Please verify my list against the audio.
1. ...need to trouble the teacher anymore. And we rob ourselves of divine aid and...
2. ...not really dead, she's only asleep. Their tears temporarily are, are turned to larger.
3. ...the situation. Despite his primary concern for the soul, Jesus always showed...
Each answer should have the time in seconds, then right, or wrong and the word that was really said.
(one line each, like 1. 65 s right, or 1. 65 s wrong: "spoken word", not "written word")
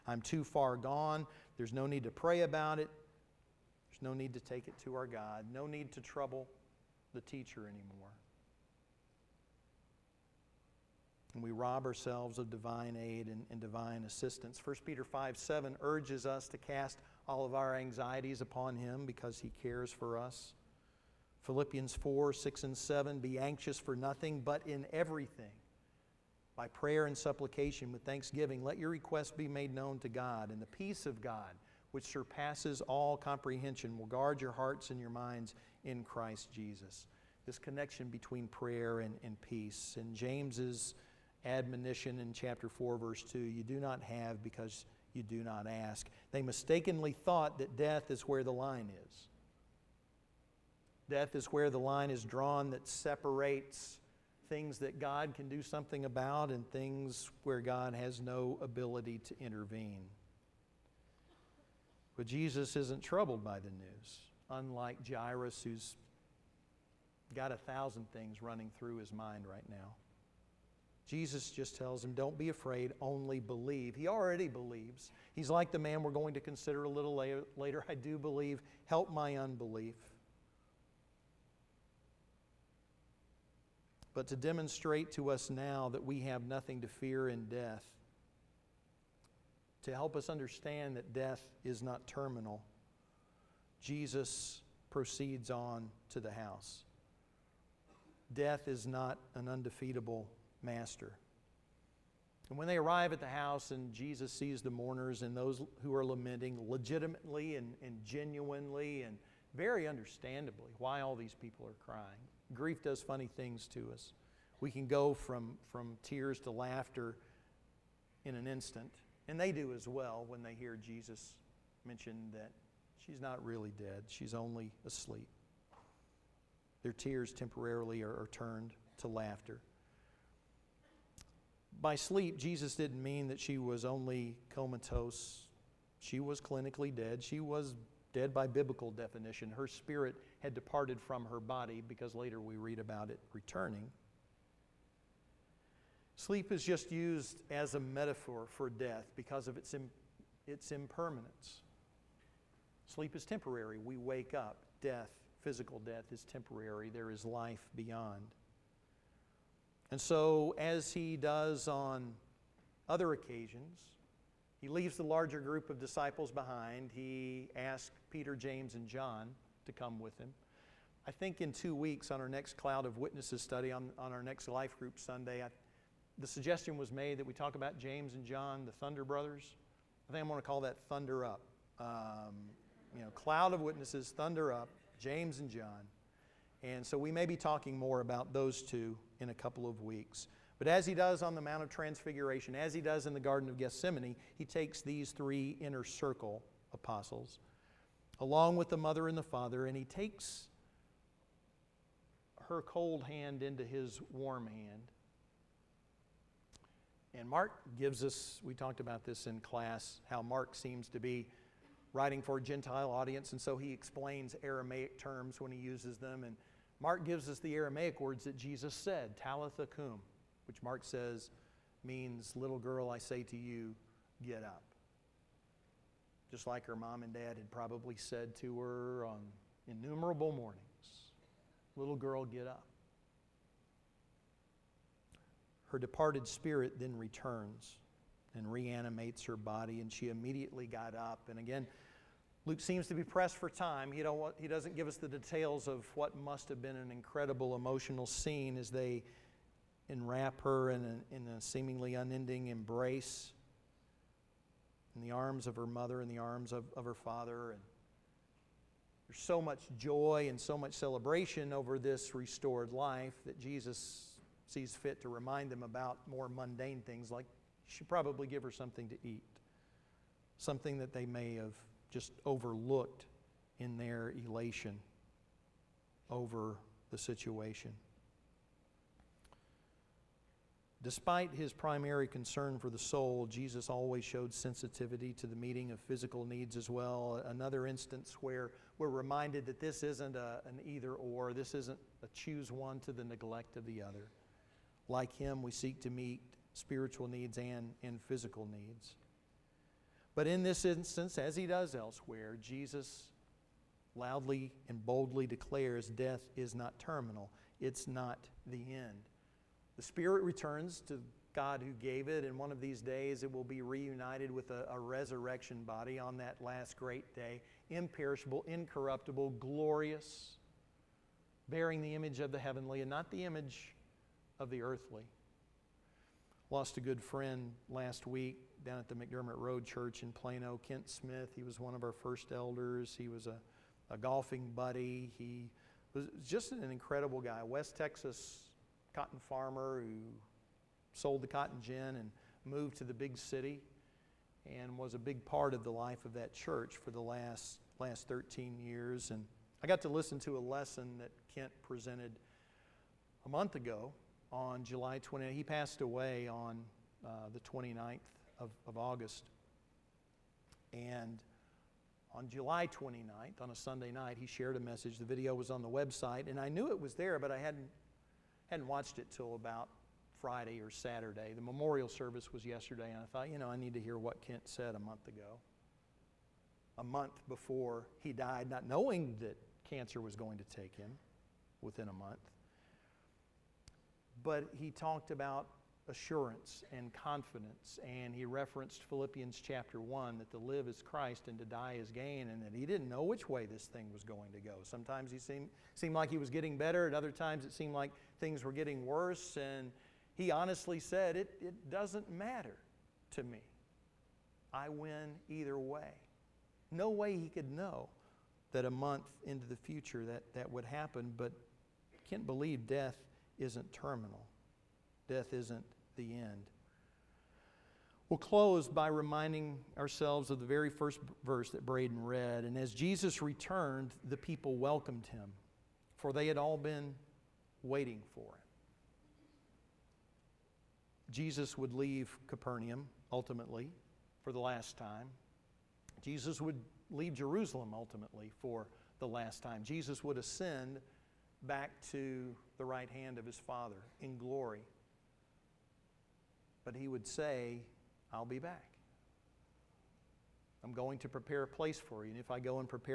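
1. 5 s right
2. 123 s wrong: "laughter", not "larger"
3. 276 s right.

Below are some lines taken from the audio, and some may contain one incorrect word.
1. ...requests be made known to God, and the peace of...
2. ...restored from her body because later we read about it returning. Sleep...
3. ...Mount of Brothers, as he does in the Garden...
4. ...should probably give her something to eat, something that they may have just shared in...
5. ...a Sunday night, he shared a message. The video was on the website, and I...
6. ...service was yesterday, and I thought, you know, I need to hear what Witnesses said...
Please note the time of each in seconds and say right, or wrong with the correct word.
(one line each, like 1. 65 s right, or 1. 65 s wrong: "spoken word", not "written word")
1. 28 s right
2. 140 s wrong: "departed", not "restored"
3. 191 s wrong: "Transfiguration", not "Brothers"
4. 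267 s wrong: "overlooked", not "shared"
5. 363 s right
6. 371 s wrong: "Kent", not "Witnesses".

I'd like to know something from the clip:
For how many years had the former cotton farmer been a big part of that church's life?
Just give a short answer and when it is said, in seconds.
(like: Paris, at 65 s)
13, at 348 s.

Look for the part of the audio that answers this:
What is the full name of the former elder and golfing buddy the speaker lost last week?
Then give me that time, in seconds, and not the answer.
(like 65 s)
330 s.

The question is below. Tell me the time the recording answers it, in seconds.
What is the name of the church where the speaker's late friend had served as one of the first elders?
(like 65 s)
328 s.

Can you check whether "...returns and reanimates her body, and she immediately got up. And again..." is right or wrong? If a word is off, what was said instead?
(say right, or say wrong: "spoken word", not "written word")
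right.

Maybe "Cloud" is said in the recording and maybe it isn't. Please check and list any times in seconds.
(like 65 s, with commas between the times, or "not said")
172 s, 183 s.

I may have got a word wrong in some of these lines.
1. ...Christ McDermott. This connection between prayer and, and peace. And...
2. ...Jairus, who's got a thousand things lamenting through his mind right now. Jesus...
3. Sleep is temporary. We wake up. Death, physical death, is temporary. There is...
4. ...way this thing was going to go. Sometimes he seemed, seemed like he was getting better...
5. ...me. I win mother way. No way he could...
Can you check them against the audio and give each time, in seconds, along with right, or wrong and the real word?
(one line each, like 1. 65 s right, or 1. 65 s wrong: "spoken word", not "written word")
1. 36 s wrong: "Jesus", not "McDermott"
2. 65 s wrong: "running", not "lamenting"
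3. 152 s right
4. 393 s right
5. 403 s wrong: "either", not "mother".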